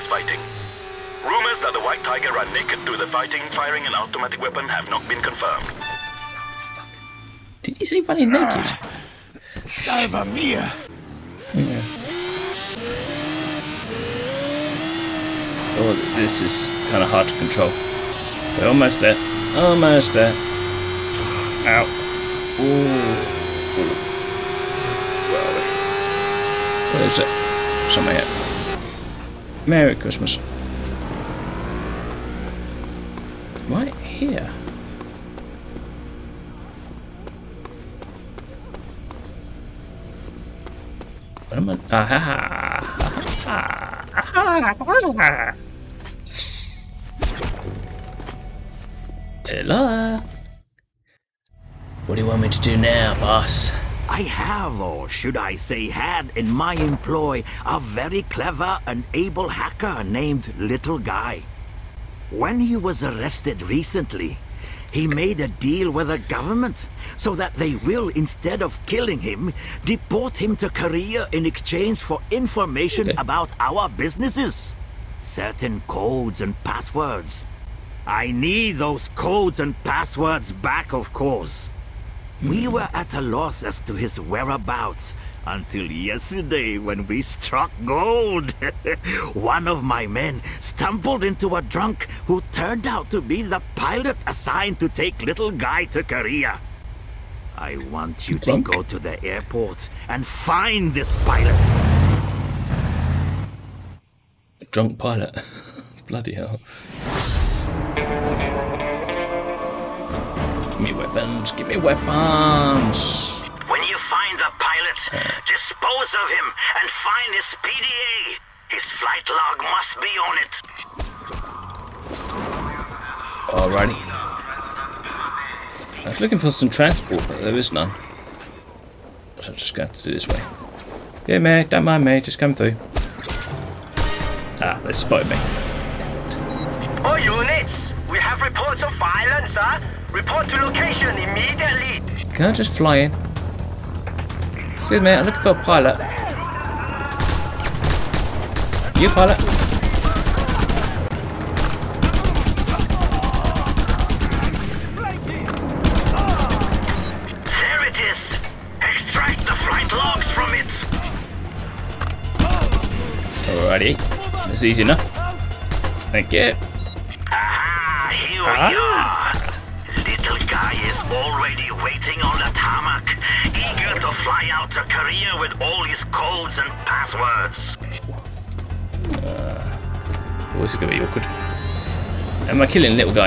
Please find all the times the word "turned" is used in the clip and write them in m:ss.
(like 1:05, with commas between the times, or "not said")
1:32.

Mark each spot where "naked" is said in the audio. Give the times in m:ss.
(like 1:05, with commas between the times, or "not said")
0:02, 0:08.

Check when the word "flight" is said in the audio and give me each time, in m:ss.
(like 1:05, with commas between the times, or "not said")
1:58.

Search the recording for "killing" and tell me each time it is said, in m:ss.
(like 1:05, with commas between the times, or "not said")
1:08, 3:02.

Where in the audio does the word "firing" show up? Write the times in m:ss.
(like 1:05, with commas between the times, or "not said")
0:03.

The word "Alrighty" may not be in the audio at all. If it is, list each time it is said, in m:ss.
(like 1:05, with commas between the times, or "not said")
2:03, 2:29.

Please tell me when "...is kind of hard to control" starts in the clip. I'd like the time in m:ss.
0:16.